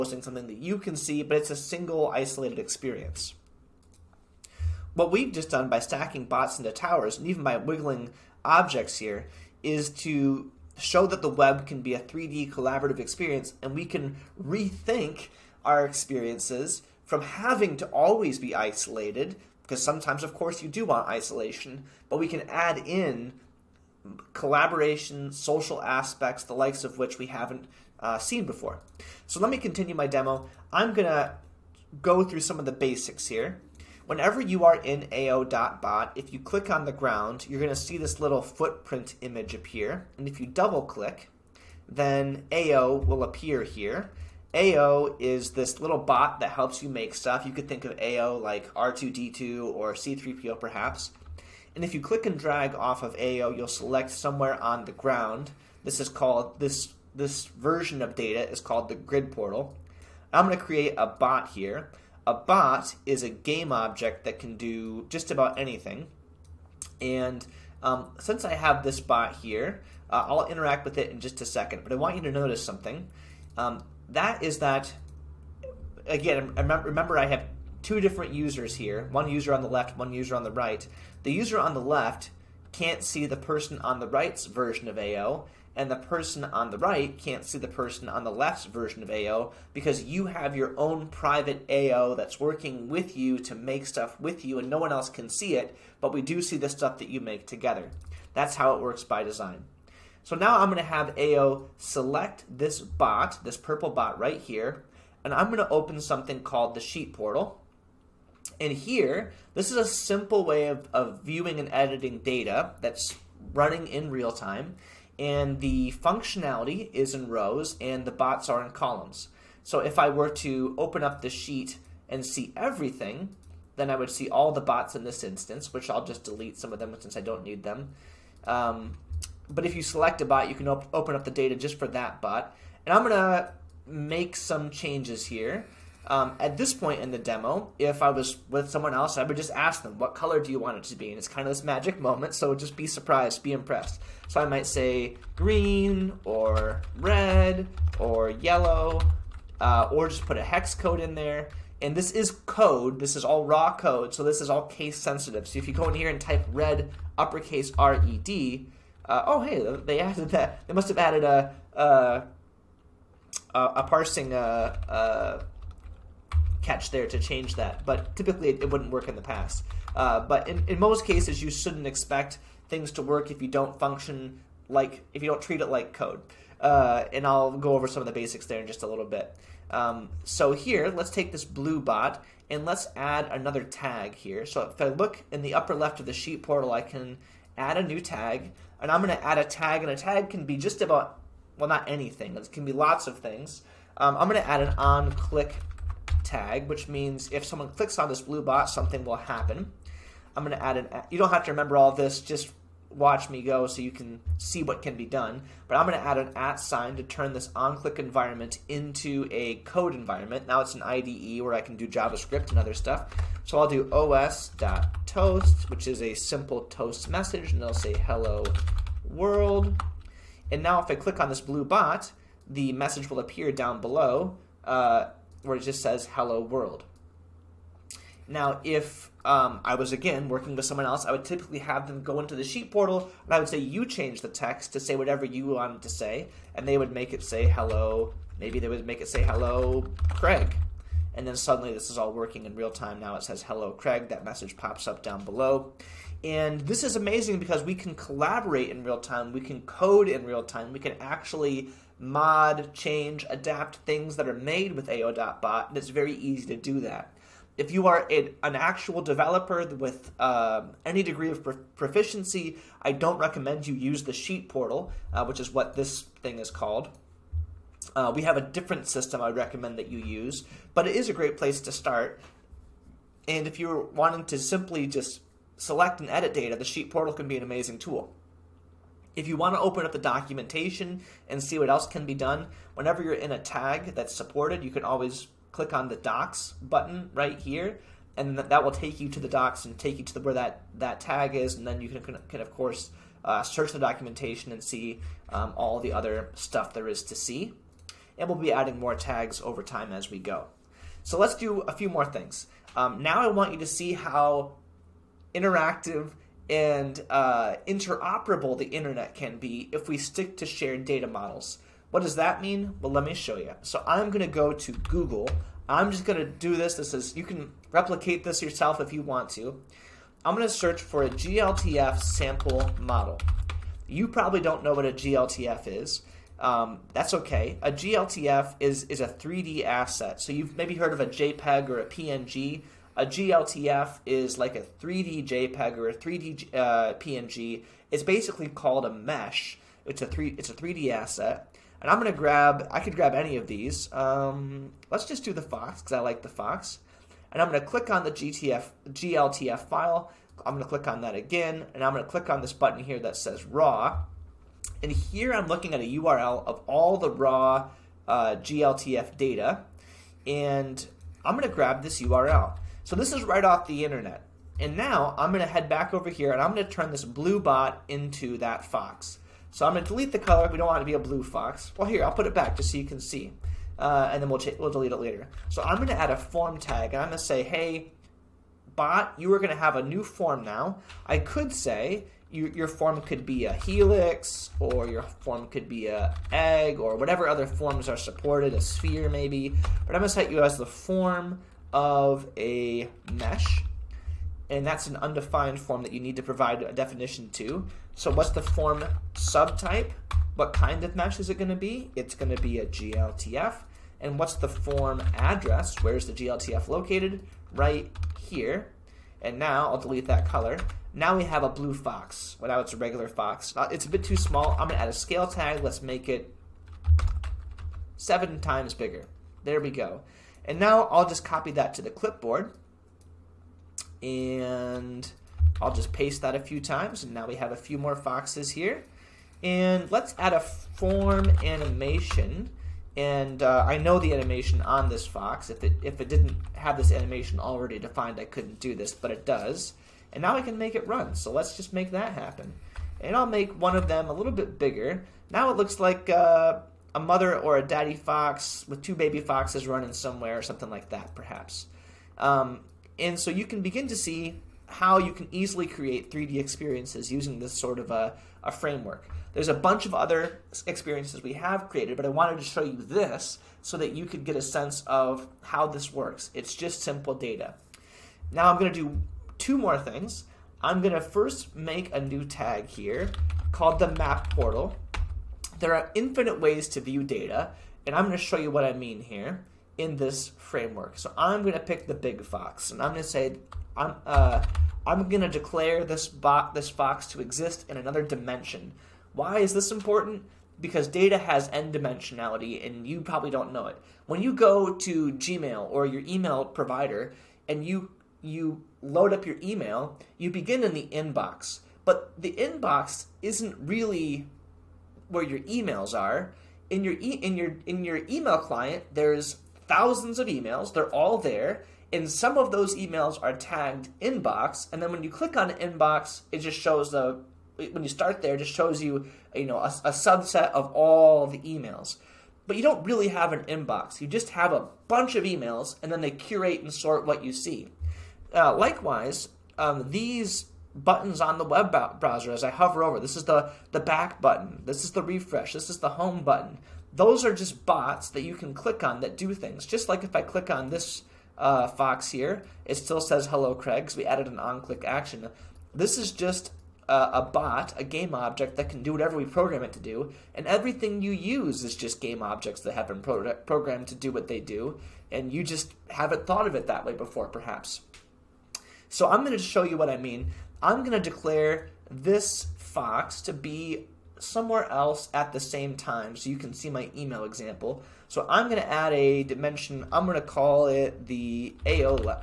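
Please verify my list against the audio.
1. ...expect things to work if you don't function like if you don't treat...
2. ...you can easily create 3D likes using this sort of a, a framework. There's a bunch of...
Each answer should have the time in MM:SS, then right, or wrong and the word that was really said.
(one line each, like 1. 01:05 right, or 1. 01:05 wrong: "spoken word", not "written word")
1. 02:51 right
2. 07:34 wrong: "experiences", not "likes".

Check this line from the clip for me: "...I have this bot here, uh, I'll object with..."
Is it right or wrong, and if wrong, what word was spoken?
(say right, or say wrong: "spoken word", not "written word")
wrong: "interact", not "object".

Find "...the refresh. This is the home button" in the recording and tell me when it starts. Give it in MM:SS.
08:54.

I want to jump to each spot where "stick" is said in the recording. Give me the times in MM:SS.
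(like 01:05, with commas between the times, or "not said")
05:09.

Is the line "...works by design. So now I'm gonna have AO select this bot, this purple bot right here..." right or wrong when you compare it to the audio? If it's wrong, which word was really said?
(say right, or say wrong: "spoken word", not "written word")
right.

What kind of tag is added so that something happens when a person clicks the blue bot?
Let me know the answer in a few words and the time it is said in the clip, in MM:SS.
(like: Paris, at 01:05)
on-click tag, at 03:14.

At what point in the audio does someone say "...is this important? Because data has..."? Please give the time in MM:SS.
08:09.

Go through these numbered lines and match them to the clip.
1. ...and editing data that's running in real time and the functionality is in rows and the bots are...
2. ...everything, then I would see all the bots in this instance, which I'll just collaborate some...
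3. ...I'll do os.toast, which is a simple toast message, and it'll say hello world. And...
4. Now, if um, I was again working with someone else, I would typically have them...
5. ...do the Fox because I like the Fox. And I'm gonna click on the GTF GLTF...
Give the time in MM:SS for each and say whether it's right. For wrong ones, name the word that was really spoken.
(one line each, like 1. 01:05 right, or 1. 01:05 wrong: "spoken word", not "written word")
1. 01:51 right
2. 02:02 wrong: "delete", not "collaborate"
3. 03:33 right
4. 03:48 right
5. 05:45 right.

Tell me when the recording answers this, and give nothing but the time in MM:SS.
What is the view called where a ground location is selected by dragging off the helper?
00:58.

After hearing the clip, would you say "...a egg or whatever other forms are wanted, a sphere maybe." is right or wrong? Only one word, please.
wrong.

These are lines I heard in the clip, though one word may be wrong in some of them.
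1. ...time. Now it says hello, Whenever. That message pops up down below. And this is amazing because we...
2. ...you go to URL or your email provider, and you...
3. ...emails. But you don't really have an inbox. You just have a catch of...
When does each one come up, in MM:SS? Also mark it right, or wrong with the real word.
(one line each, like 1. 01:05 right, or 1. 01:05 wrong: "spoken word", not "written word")
1. 04:02 wrong: "Craig", not "Whenever"
2. 08:14 wrong: "Gmail", not "URL"
3. 08:41 wrong: "bunch", not "catch".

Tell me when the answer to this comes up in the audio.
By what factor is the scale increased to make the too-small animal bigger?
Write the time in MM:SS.
06:57.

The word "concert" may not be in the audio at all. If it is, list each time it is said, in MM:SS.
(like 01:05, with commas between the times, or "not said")
not said.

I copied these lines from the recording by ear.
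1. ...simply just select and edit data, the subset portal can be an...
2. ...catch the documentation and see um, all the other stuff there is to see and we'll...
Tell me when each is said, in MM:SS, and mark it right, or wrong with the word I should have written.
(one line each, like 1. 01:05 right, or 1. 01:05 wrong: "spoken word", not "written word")
1. 04:34 wrong: "sheet", not "subset"
2. 04:53 wrong: "search", not "catch".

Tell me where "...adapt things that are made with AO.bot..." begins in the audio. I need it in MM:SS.
04:13.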